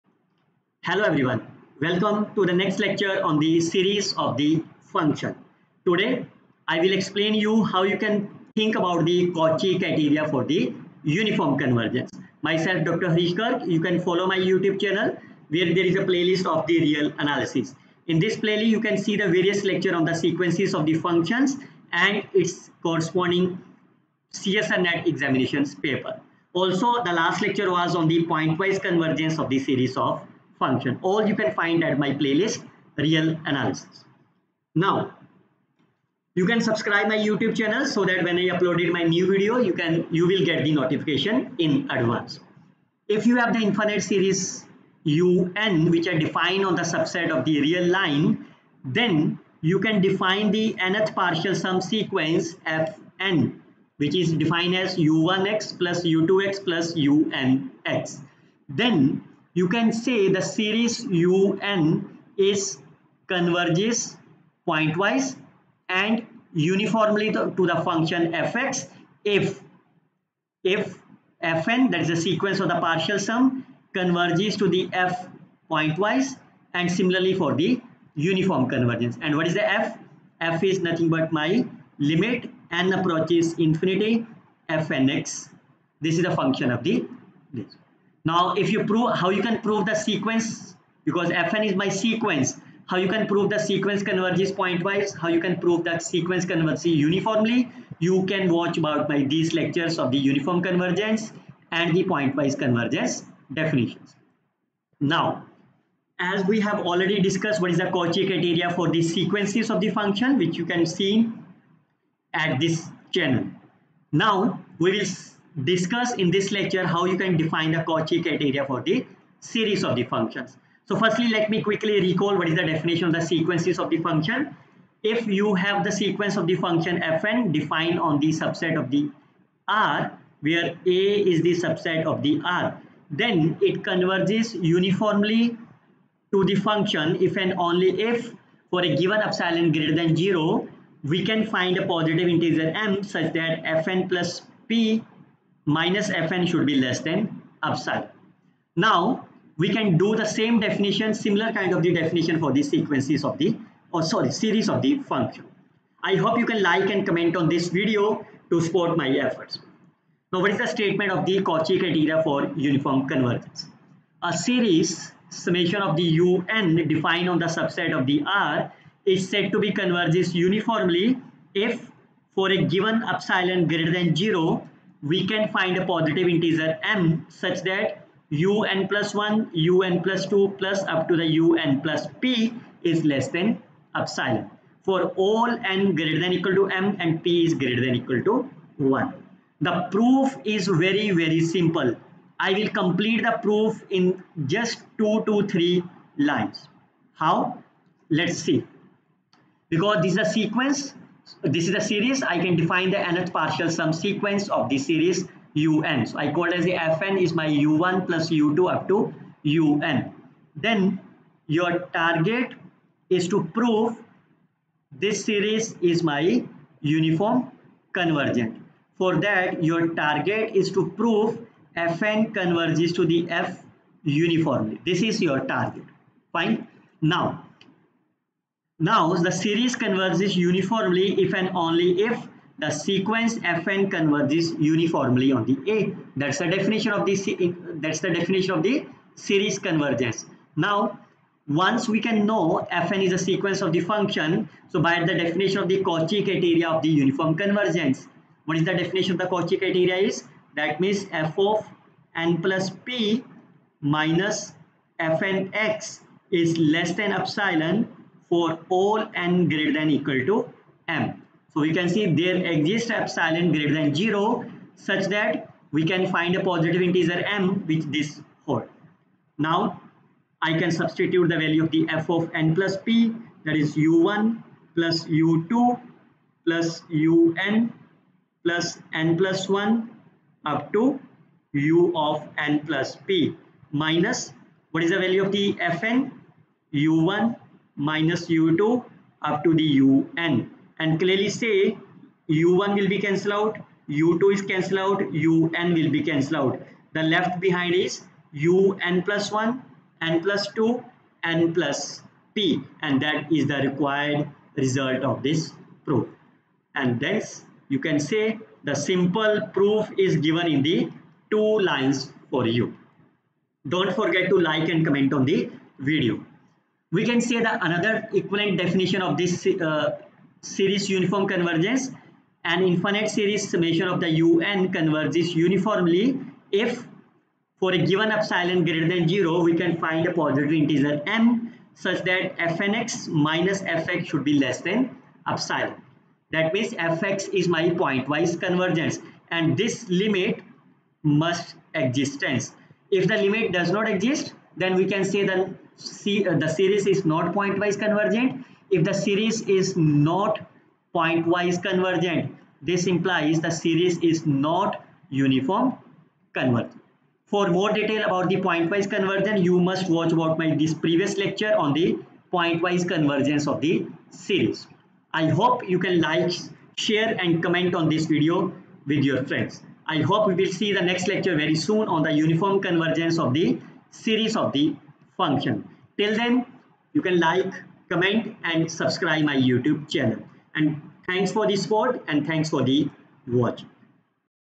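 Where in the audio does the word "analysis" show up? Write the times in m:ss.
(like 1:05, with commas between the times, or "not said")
0:17, 0:33.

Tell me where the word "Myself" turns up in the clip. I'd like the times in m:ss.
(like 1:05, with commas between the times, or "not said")
0:12.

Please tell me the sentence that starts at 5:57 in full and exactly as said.
For more detail about the pointwise convergence, you must watch about my this previous lecture on the pointwise convergence of the series.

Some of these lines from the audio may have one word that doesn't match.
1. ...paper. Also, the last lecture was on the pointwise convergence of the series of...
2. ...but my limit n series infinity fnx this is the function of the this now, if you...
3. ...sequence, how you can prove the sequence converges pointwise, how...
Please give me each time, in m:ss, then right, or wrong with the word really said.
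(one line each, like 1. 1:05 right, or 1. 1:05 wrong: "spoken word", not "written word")
1. 0:25 right
2. 1:21 wrong: "approaches", not "series"
3. 1:31 right.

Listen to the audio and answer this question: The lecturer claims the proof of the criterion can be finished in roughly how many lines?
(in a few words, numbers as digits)
2 to 3.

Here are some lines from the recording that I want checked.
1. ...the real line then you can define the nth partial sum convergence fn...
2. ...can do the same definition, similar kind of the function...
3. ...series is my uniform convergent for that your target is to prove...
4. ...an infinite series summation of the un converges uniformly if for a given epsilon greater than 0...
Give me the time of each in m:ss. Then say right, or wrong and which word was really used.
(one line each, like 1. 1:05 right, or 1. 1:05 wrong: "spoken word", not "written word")
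1. 0:47 wrong: "sequence", not "convergence"
2. 2:29 wrong: "definition", not "function"
3. 3:35 right
4. 5:22 right.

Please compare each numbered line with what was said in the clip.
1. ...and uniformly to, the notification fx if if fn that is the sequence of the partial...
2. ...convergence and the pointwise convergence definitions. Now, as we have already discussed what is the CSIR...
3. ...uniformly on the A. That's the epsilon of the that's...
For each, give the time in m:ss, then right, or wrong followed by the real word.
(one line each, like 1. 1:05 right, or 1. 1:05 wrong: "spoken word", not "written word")
1. 1:05 wrong: "function", not "notification"
2. 1:40 wrong: "Cauchy", not "CSIR"
3. 3:54 wrong: "definition", not "epsilon".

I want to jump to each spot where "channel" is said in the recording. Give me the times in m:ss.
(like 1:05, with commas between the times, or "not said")
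0:14, 0:37, 1:53, 6:19.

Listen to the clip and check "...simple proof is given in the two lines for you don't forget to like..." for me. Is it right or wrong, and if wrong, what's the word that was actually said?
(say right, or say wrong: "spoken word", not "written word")
right.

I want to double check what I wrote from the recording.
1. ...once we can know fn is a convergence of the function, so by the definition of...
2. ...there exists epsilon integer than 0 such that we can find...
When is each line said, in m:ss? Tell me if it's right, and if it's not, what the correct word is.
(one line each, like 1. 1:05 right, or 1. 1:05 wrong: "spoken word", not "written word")
1. 4:01 wrong: "sequence", not "convergence"
2. 4:22 wrong: "greater", not "integer".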